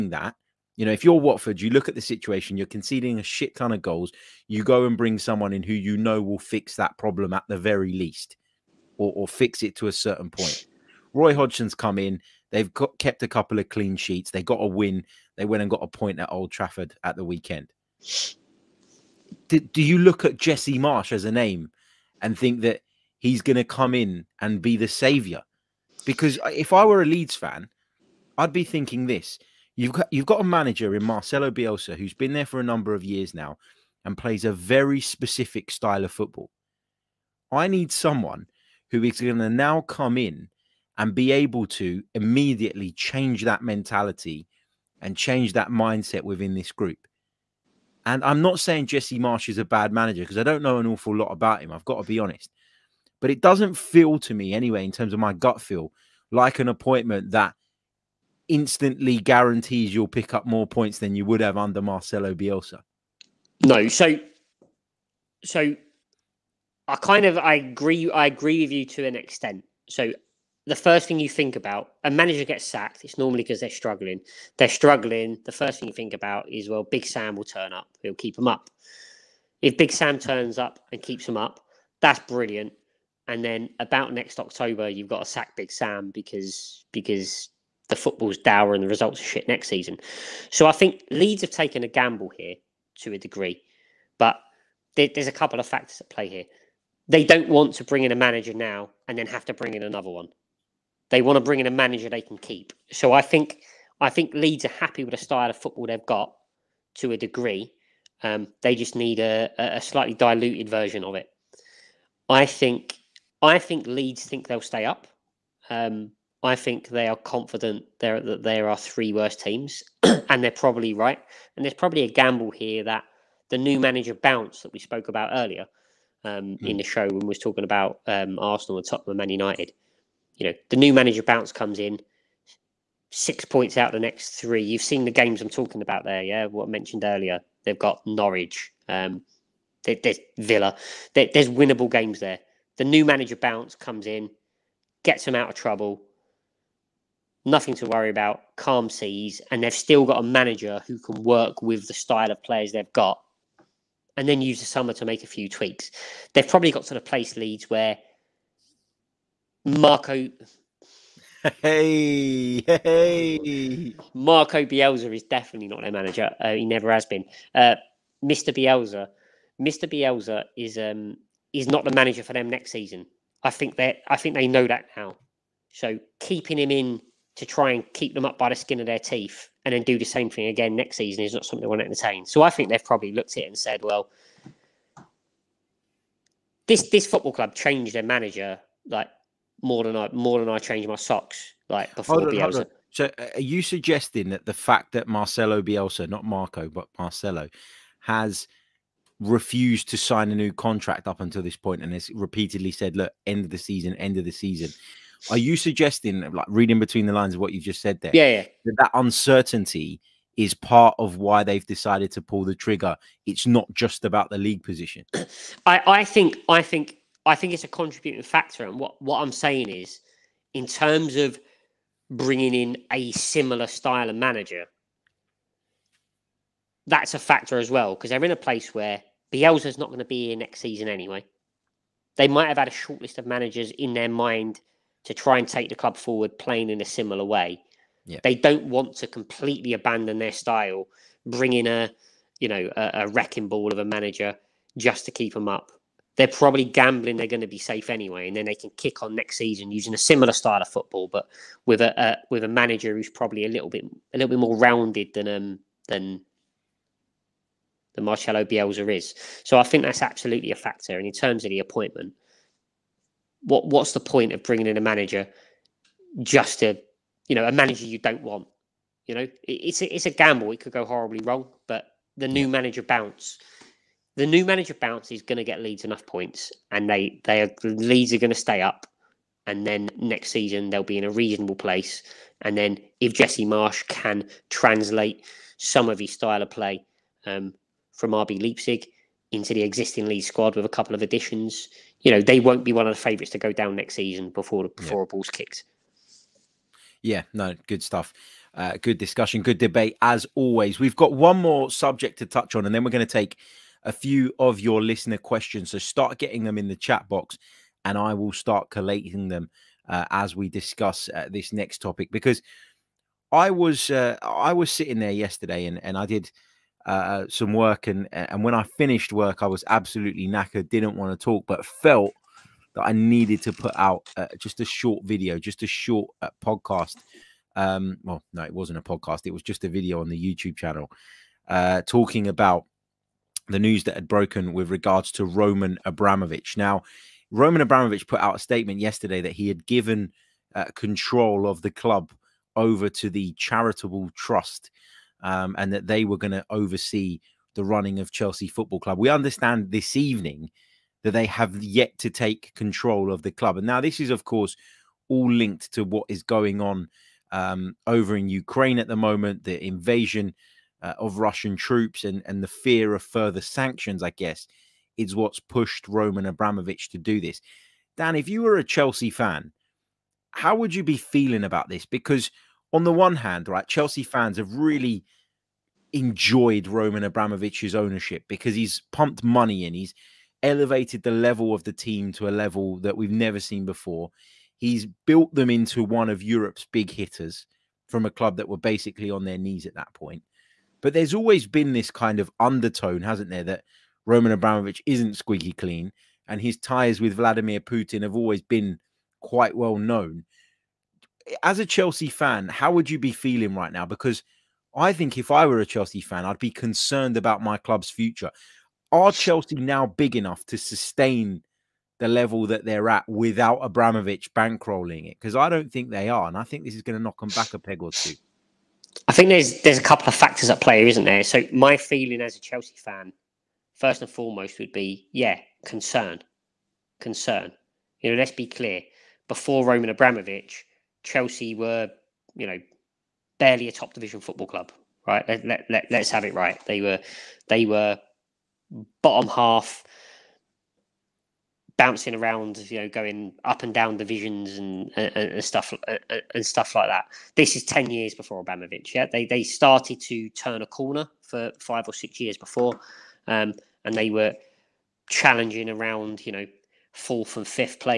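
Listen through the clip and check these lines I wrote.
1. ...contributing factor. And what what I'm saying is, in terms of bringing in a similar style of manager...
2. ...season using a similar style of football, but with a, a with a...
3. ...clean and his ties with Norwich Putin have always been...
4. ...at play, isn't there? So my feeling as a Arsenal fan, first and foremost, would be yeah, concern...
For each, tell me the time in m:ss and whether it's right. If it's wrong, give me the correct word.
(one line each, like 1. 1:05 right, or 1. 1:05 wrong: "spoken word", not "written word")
1. 3:37 right
2. 4:09 right
3. 6:35 wrong: "Vladimir", not "Norwich"
4. 7:00 wrong: "Chelsea", not "Arsenal".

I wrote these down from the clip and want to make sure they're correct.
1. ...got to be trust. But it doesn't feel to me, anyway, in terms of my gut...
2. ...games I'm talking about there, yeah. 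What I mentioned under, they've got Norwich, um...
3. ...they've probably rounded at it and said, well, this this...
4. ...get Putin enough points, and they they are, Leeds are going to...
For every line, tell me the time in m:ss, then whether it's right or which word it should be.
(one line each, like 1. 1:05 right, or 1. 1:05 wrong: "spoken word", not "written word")
1. 0:51 wrong: "honest", not "trust"
2. 2:15 wrong: "earlier", not "under"
3. 3:02 wrong: "looked", not "rounded"
4. 4:35 wrong: "Leeds", not "Putin".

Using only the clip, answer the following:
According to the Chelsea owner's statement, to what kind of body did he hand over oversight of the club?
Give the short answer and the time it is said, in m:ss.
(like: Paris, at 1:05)
charitable trust, at 5:43.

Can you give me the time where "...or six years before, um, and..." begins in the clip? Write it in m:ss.
7:31.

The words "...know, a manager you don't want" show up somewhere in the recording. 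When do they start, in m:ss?
4:27.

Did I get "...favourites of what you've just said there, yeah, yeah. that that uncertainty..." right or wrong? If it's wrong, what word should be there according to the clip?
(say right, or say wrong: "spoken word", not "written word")
wrong: "lines", not "favourites".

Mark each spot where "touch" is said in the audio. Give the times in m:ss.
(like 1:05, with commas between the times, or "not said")
5:02.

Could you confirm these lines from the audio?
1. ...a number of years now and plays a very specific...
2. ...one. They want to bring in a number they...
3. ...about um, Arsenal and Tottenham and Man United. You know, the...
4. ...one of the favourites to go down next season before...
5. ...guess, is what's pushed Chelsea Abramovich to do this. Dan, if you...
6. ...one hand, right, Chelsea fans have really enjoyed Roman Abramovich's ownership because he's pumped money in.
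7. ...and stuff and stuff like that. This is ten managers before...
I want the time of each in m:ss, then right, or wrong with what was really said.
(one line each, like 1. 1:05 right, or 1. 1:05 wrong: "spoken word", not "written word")
1. 0:32 right
2. 1:40 wrong: "manager", not "number"
3. 2:07 right
4. 4:52 right
5. 6:04 wrong: "Roman", not "Chelsea"
6. 6:12 right
7. 7:25 wrong: "years", not "managers".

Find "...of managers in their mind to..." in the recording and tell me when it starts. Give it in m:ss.
3:53.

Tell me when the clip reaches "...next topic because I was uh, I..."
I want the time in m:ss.
5:11.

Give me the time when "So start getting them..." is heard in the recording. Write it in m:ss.
5:05.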